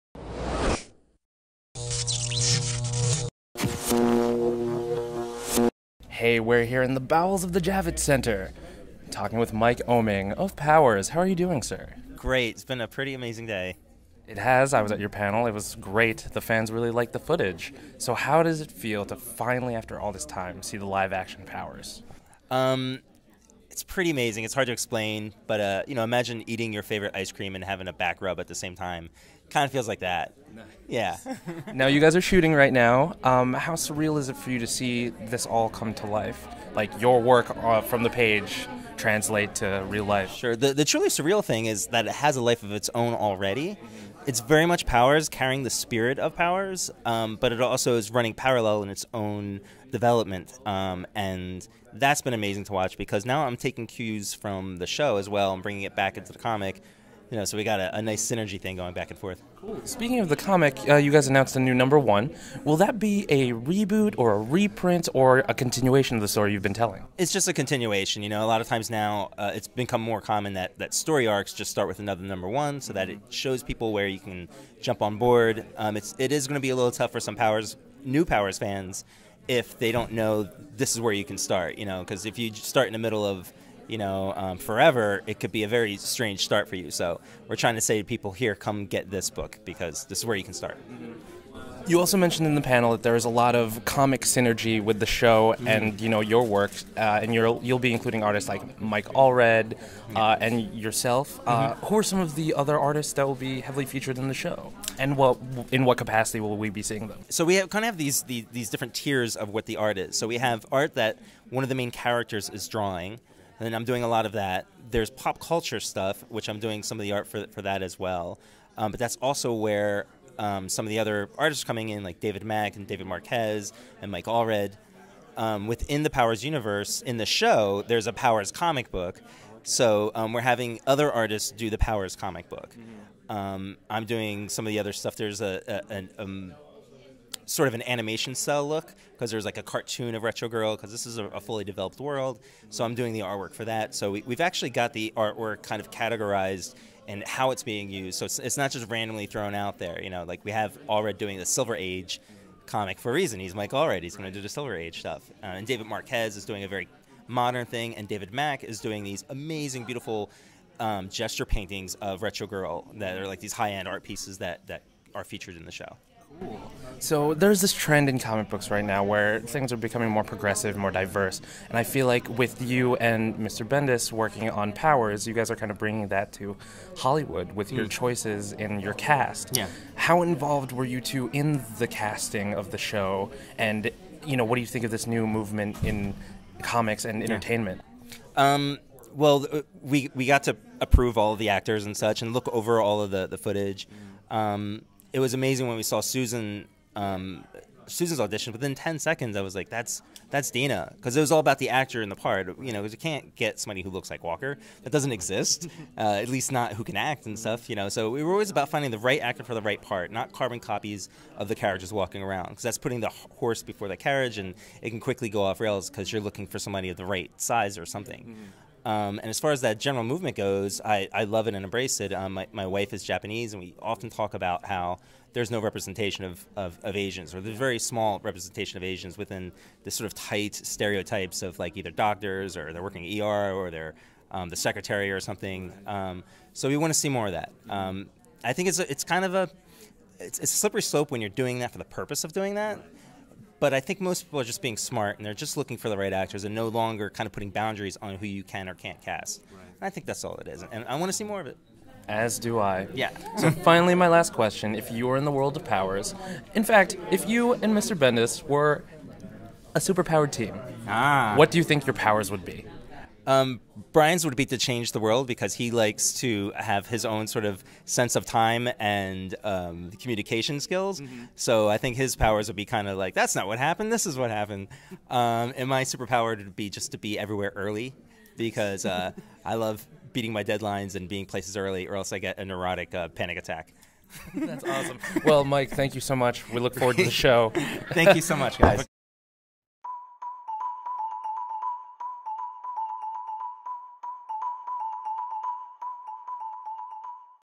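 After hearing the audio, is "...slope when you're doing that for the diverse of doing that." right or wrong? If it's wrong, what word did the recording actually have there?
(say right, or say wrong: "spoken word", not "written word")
wrong: "purpose", not "diverse".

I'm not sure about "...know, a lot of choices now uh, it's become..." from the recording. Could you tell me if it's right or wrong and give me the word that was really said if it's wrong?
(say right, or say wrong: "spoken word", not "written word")
wrong: "times", not "choices".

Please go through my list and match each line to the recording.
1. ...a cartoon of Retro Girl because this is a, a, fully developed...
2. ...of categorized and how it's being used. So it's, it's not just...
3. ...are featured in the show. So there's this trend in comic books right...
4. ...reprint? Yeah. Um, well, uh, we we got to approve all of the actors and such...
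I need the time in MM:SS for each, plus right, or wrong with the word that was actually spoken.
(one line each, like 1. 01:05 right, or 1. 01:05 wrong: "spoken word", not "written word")
1. 02:19 right
2. 02:25 right
3. 02:45 right
4. 03:07 wrong: "entertainment", not "reprint".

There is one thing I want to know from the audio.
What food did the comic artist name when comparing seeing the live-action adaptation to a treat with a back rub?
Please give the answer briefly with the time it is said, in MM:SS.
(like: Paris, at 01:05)
ice cream, at 00:27.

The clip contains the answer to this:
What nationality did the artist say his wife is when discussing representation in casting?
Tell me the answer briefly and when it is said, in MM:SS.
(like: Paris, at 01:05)
Japanese, at 03:43.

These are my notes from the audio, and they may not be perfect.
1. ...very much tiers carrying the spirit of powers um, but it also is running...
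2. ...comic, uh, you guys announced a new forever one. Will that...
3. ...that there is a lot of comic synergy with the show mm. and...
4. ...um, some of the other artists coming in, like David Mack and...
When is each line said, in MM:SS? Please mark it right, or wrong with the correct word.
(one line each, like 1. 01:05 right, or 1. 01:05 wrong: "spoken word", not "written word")
1. 00:44 wrong: "powers", not "tiers"
2. 01:00 wrong: "number", not "forever"
3. 01:32 right
4. 02:00 right.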